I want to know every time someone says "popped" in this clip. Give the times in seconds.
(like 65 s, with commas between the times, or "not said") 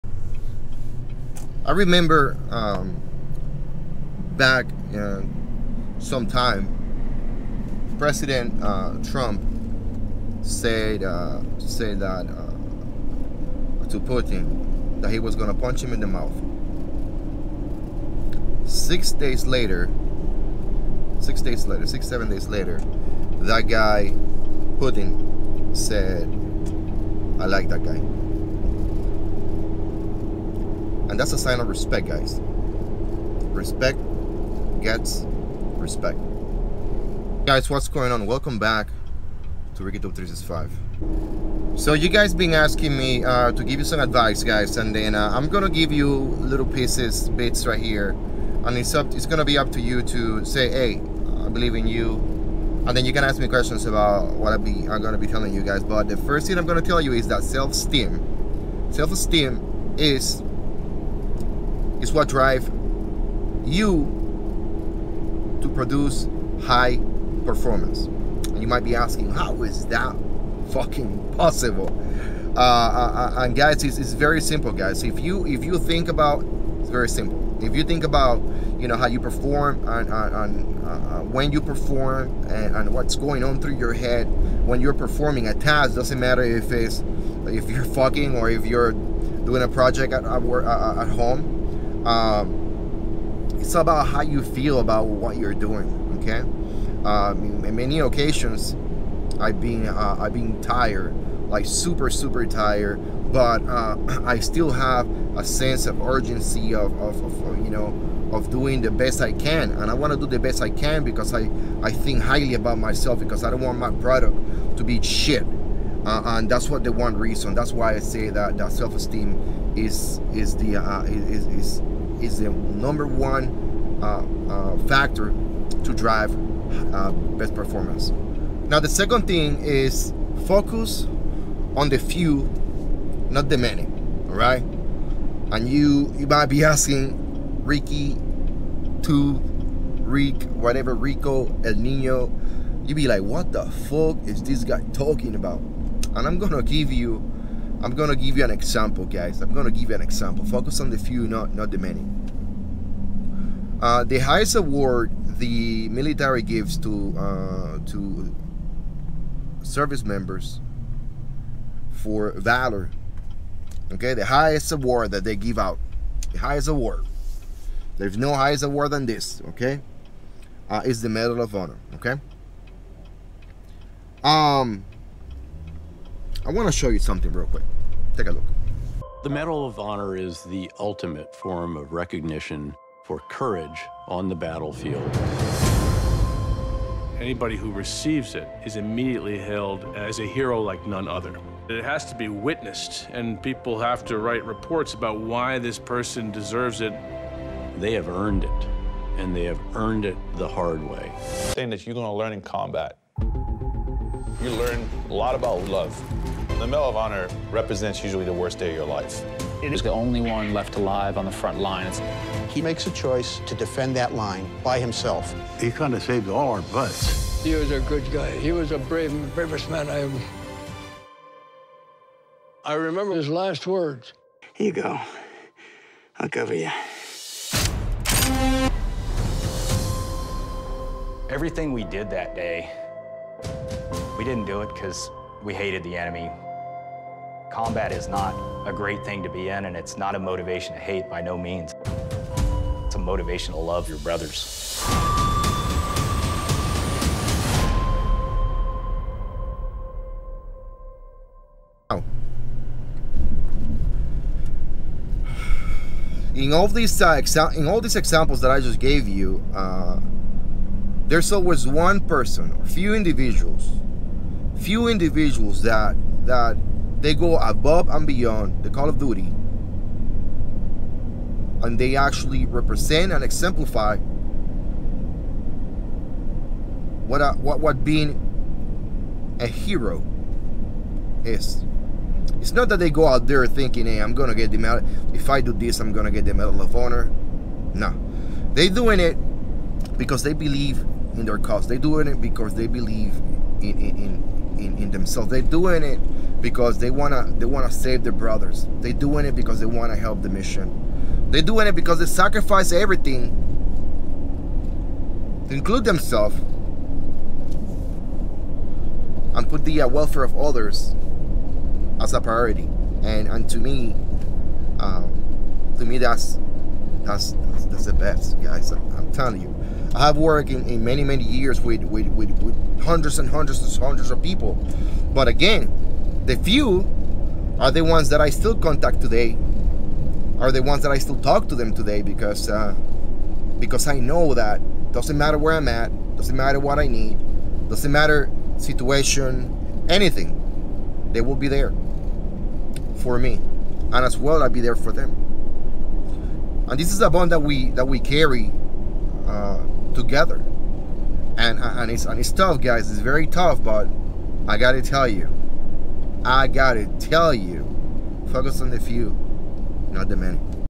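not said.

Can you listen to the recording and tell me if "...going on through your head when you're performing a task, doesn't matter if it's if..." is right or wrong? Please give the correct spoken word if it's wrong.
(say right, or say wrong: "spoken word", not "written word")
right.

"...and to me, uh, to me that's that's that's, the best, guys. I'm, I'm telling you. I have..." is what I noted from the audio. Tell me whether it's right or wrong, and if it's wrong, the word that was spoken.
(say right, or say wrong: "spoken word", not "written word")
right.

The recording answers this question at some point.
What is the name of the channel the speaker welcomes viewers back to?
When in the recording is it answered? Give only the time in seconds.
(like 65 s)
39 s.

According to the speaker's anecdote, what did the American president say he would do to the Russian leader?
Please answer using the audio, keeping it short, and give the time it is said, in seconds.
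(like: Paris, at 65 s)
punch him in the mouth, at 15 s.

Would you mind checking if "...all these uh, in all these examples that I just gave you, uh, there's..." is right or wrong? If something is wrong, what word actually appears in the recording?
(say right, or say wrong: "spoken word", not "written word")
right.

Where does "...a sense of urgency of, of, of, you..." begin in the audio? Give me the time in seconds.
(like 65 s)
105 s.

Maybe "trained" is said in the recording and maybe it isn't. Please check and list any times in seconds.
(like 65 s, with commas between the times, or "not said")
not said.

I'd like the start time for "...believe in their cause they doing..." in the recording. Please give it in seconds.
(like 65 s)
290 s.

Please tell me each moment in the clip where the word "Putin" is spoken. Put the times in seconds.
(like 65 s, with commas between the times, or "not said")
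13 s, 24 s.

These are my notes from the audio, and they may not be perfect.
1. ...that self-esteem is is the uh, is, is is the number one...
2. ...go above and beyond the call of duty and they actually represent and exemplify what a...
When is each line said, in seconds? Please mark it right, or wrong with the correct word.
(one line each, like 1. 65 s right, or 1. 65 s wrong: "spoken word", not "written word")
1. 118 s right
2. 267 s right.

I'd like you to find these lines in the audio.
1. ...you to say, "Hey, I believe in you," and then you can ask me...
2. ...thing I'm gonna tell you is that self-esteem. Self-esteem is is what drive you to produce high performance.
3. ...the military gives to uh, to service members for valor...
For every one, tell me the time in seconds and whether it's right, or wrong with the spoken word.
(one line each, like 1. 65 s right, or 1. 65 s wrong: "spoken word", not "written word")
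1. 49 s right
2. 56 s right
3. 155 s right.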